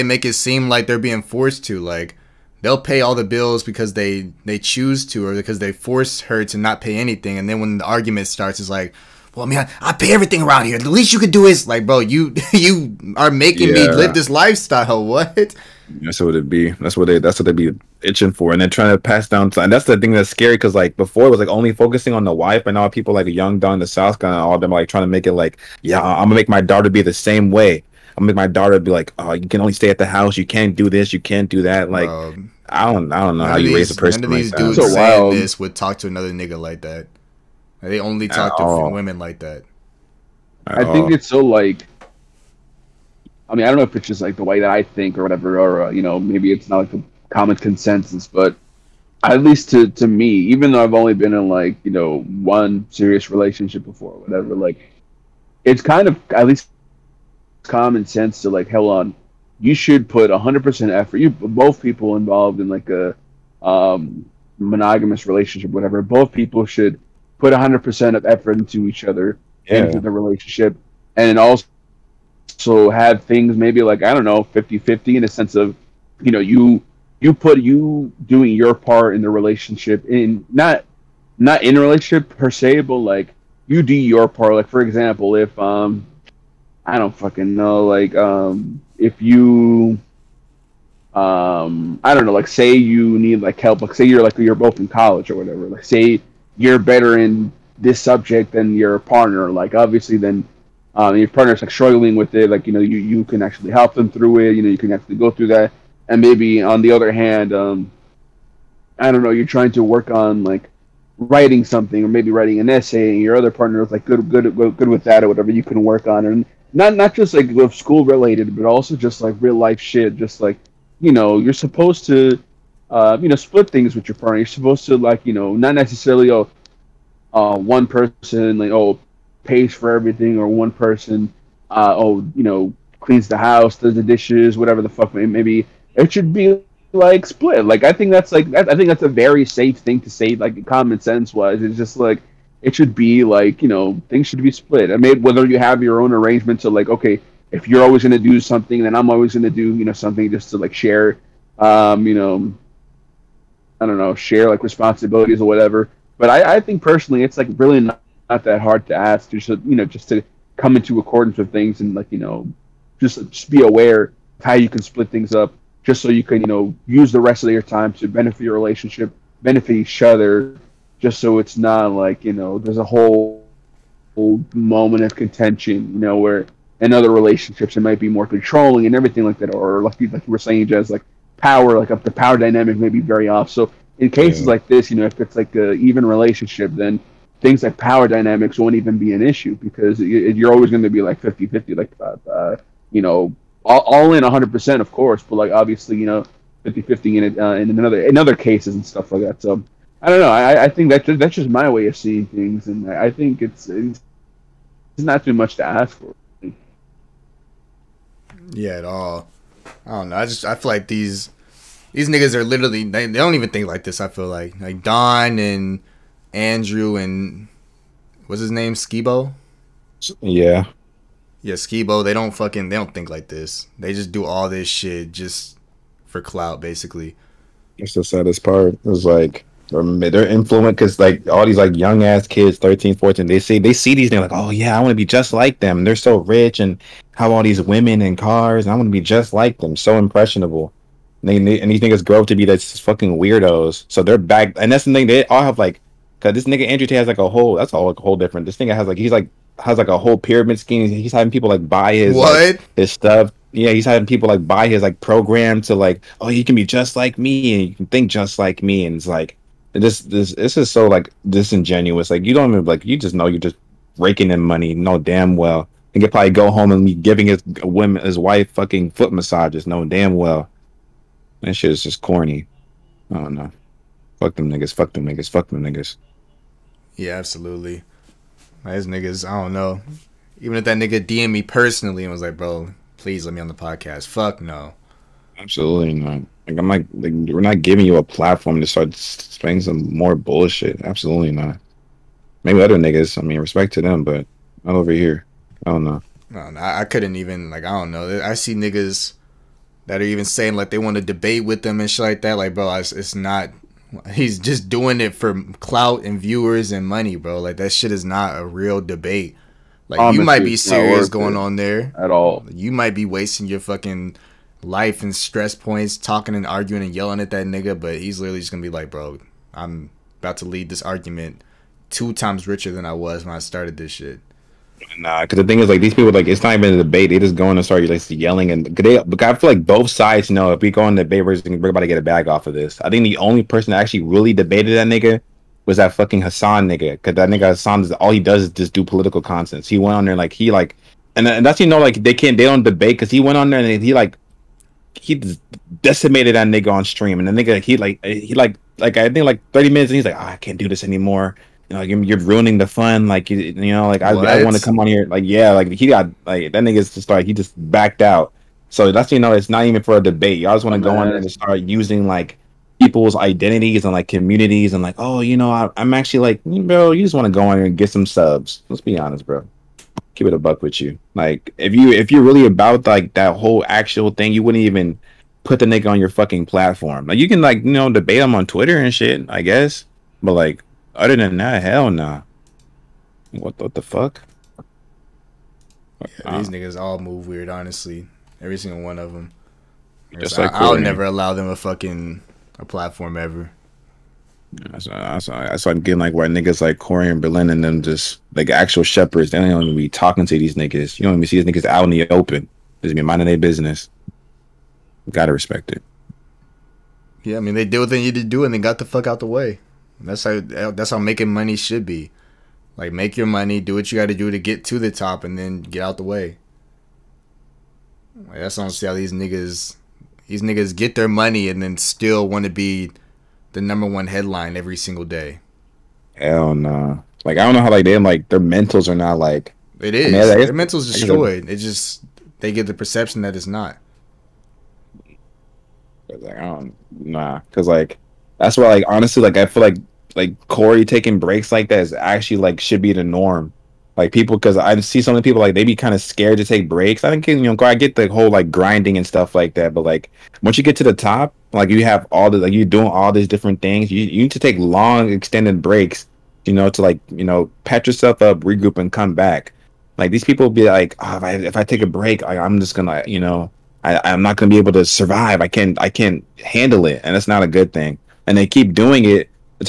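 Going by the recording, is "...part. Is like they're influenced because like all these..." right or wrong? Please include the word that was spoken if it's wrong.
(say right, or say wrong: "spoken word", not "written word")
right.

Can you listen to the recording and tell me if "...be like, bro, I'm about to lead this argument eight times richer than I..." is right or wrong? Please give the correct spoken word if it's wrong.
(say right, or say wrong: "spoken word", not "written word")
wrong: "two", not "eight".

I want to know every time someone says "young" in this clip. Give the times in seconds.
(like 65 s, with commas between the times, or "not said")
23 s, 231 s.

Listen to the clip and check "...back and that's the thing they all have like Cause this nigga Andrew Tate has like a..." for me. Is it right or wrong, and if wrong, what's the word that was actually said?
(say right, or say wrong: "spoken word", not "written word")
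right.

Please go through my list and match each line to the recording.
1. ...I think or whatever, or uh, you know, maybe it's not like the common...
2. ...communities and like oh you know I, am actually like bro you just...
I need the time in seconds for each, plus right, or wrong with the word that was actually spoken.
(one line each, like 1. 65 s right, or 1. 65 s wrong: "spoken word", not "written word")
1. 44 s right
2. 364 s right.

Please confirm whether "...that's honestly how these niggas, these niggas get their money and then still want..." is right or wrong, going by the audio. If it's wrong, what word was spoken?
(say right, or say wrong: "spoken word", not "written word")
right.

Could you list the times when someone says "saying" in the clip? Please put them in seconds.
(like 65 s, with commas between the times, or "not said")
34 s, 180 s, 300 s.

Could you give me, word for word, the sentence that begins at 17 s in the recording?
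That's what they'd be itching for, and they're trying to pass down.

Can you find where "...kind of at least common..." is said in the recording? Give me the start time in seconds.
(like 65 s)
55 s.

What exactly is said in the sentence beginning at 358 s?
So that's you know, it's not even for a debate.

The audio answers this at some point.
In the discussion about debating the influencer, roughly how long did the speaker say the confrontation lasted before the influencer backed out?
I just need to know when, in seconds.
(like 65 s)
349 s.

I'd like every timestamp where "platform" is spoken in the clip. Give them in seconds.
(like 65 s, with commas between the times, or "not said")
288 s, 376 s, 392 s.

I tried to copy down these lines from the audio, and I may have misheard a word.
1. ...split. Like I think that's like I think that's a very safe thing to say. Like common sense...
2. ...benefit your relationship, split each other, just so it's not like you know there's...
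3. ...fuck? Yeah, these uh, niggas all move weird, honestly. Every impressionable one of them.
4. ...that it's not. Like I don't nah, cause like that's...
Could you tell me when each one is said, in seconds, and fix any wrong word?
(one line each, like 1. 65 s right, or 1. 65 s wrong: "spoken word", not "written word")
1. 137 s right
2. 168 s wrong: "benefit", not "split"
3. 383 s wrong: "single", not "impressionable"
4. 433 s right.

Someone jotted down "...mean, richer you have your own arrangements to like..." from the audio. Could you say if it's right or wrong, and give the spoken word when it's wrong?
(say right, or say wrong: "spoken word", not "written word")
wrong: "whether", not "richer".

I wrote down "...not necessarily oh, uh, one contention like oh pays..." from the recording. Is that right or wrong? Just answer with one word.
wrong.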